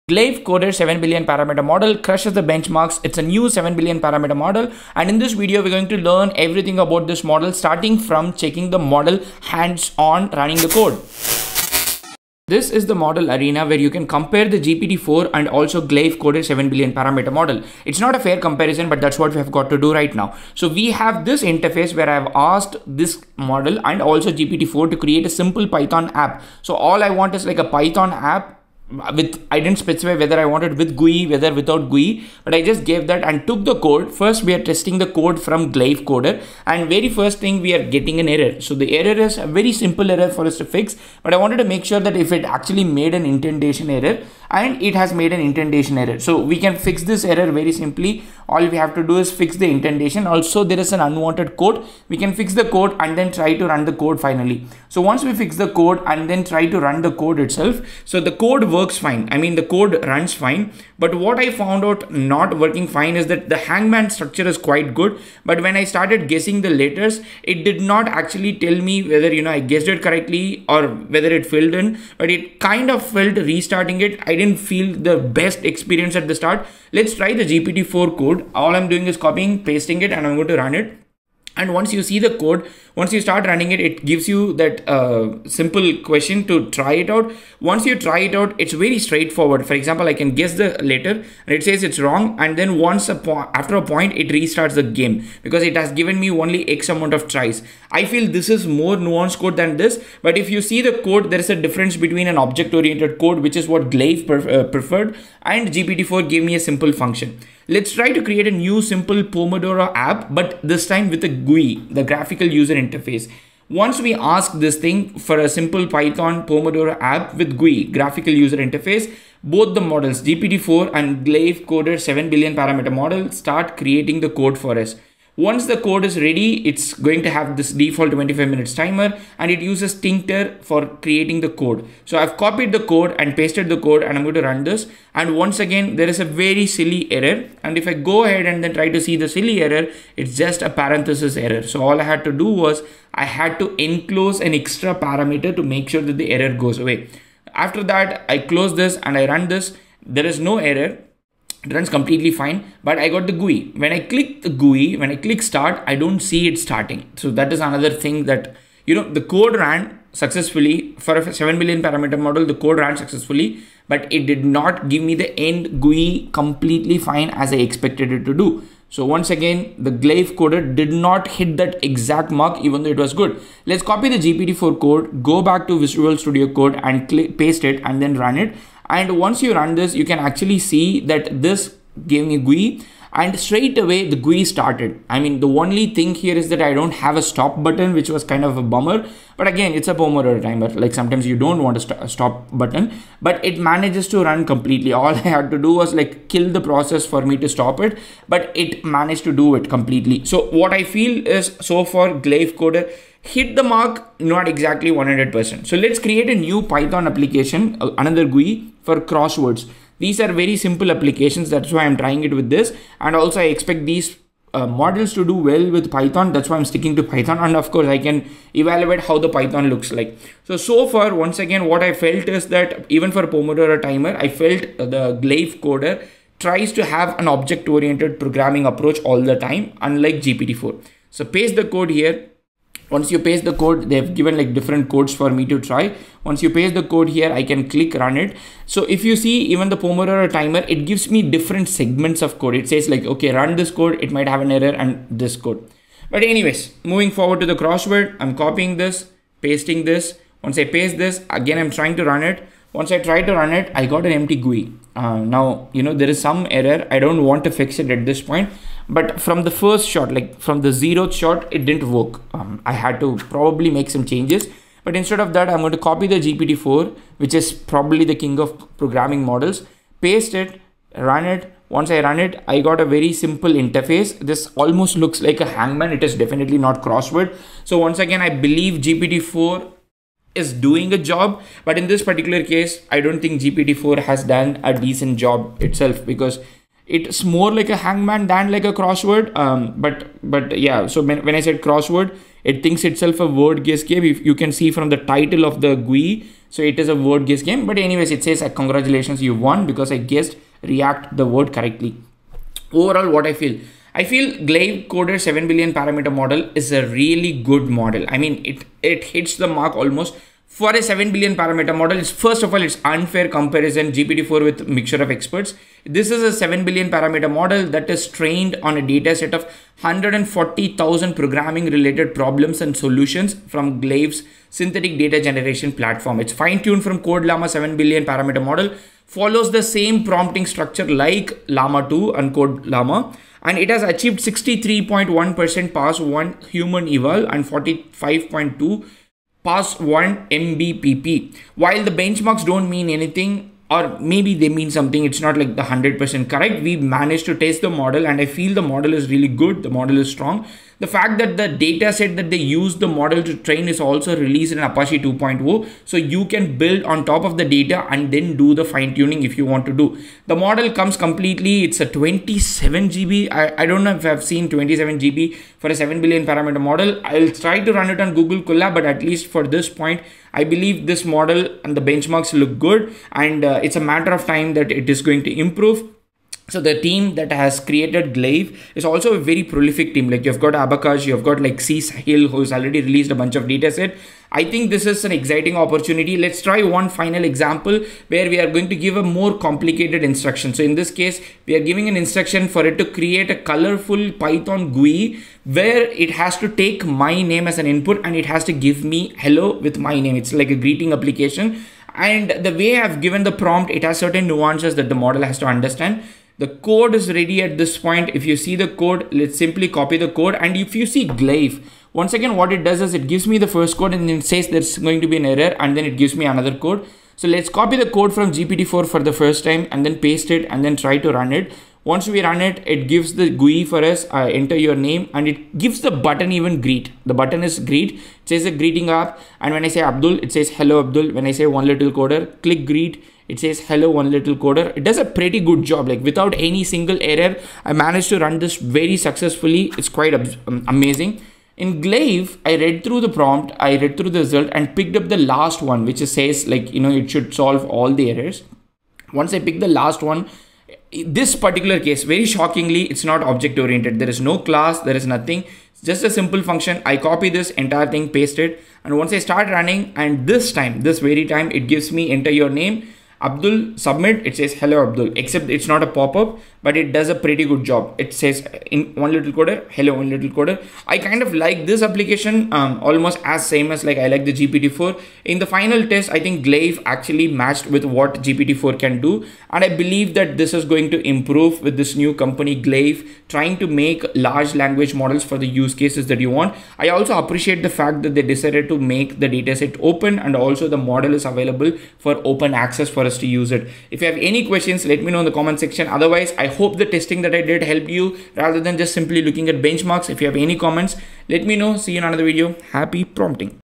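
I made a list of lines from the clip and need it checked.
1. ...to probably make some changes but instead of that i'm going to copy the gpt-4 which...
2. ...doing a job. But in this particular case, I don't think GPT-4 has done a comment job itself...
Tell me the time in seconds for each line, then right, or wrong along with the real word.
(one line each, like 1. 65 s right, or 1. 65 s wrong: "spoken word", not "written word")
1. 263 s right
2. 280 s wrong: "decent", not "comment".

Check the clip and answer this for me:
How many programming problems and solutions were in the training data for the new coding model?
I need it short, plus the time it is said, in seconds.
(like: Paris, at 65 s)
140000, at 319 s.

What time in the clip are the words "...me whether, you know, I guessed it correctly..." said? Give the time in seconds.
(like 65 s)
68 s.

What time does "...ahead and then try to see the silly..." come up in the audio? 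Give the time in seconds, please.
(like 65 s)
138 s.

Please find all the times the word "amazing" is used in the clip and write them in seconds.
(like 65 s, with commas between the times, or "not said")
440 s.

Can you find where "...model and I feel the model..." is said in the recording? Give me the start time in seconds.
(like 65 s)
347 s.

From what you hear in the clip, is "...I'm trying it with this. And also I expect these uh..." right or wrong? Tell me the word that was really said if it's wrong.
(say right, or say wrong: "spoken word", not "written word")
right.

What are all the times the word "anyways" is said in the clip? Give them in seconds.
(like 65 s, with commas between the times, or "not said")
246 s, 297 s.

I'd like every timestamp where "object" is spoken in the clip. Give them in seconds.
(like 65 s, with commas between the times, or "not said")
102 s, 227 s, 453 s.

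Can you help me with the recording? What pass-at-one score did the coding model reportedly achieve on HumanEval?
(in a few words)
63.1%.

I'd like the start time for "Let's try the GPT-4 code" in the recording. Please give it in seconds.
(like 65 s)
76 s.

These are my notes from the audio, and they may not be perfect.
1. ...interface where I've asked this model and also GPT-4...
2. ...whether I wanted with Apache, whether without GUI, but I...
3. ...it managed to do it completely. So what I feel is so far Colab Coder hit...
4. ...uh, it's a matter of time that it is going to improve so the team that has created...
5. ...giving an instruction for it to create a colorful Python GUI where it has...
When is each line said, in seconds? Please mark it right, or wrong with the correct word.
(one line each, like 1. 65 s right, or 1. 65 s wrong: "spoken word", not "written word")
1. 21 s right
2. 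30 s wrong: "GUI", not "Apache"
3. 198 s wrong: "Glaive", not "Colab"
4. 373 s right
5. 391 s right.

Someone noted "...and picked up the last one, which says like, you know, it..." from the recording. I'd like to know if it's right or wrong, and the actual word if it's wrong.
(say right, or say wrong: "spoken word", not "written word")
right.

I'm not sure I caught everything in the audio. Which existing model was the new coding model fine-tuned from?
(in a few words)
Code Llama 7B.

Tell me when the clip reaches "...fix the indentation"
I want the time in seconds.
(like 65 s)
49 s.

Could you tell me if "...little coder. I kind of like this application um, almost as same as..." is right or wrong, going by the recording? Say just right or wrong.
right.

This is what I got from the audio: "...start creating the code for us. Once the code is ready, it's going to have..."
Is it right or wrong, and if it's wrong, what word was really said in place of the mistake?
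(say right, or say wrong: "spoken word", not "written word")
right.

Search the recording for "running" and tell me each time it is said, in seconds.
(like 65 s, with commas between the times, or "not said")
10 s, 83 s, 459 s.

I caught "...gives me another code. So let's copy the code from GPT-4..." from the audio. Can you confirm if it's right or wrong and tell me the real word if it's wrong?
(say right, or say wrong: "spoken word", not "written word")
right.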